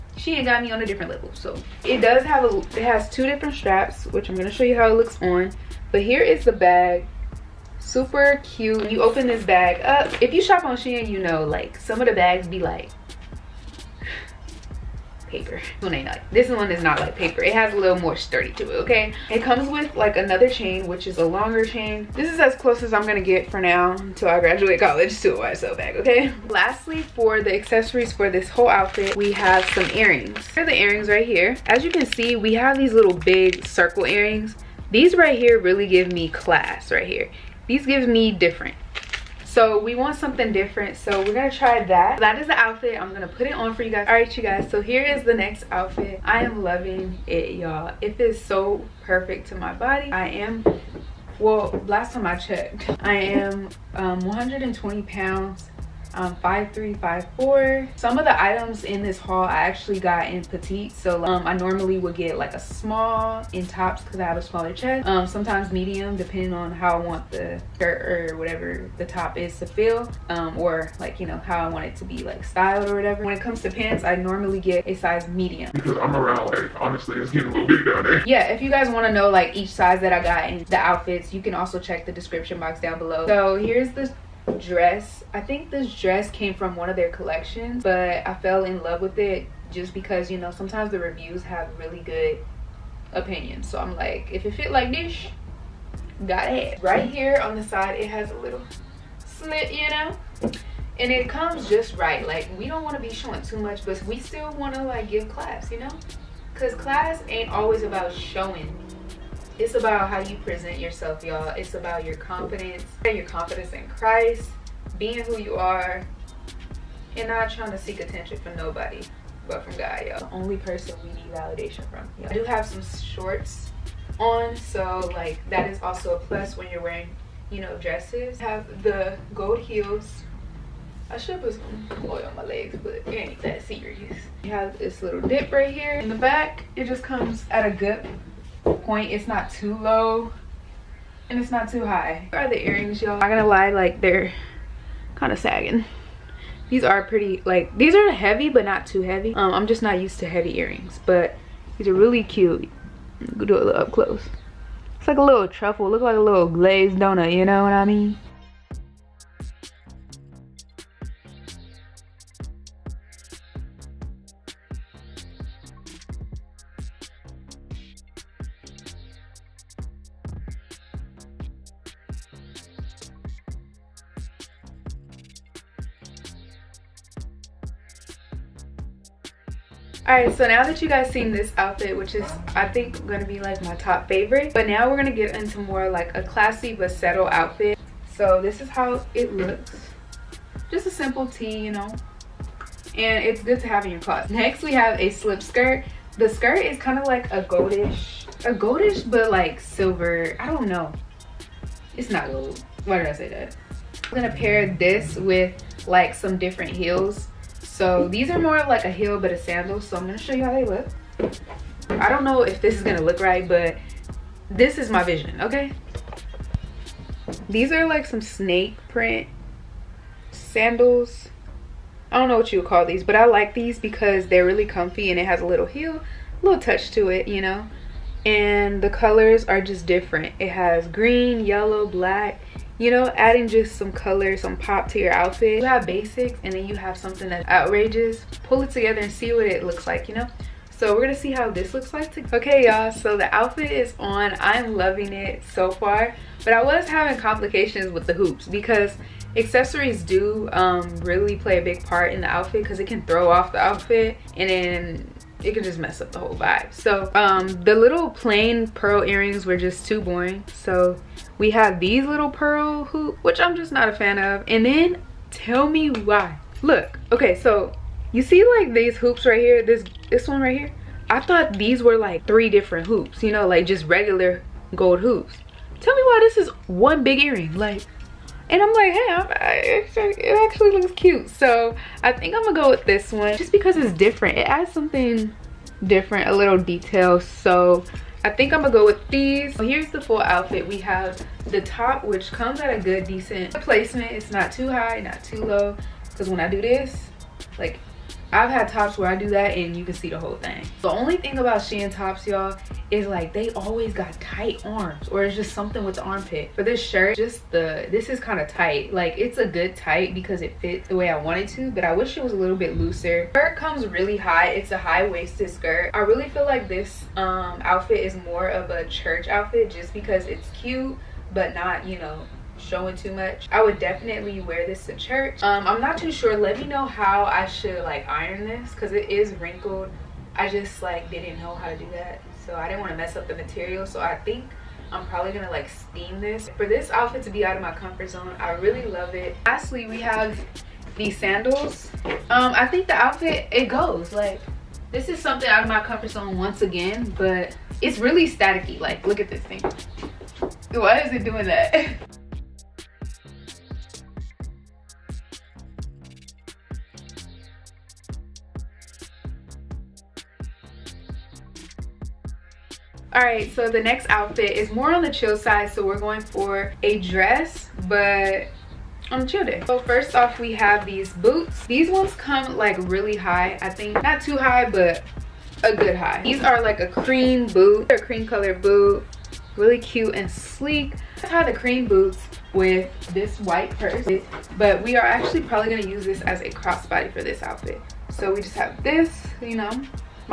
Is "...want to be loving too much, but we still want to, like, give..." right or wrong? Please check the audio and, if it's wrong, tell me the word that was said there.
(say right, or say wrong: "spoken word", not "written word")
wrong: "showing", not "loving".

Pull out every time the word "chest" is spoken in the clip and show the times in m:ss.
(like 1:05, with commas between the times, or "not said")
1:04.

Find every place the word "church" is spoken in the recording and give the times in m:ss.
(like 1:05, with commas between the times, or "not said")
5:18, 5:24.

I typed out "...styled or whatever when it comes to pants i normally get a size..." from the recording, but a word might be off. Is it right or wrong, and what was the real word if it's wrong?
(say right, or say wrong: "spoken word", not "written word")
right.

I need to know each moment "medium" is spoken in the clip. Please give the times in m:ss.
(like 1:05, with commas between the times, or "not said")
1:05, 1:15.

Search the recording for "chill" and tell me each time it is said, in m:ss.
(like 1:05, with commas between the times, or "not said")
6:05, 6:09.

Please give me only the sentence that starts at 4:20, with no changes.
So we have these little pearl hoop, which I'm just not a fan of.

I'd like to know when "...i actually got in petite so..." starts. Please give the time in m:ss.
0:59.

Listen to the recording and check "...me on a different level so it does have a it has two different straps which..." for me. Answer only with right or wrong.
right.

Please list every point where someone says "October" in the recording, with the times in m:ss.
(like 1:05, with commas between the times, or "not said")
not said.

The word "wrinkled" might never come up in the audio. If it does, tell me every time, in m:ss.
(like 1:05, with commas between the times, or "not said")
5:29.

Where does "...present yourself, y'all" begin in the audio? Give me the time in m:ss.
1:50.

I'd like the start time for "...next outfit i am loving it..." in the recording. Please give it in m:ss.
0:45.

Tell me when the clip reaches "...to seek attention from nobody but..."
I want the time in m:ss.
1:57.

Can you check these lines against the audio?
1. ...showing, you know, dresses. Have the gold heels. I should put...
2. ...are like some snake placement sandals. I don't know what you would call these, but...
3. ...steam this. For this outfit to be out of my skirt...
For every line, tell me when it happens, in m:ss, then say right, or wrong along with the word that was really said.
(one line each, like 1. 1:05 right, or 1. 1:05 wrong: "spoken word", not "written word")
1. 2:06 wrong: "wearing", not "showing"
2. 3:37 wrong: "print", not "placement"
3. 5:35 wrong: "comfort", not "skirt".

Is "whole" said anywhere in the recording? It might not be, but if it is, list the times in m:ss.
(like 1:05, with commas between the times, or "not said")
0:28, 4:16, 5:00.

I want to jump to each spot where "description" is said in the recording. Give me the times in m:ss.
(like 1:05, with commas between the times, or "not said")
1:22.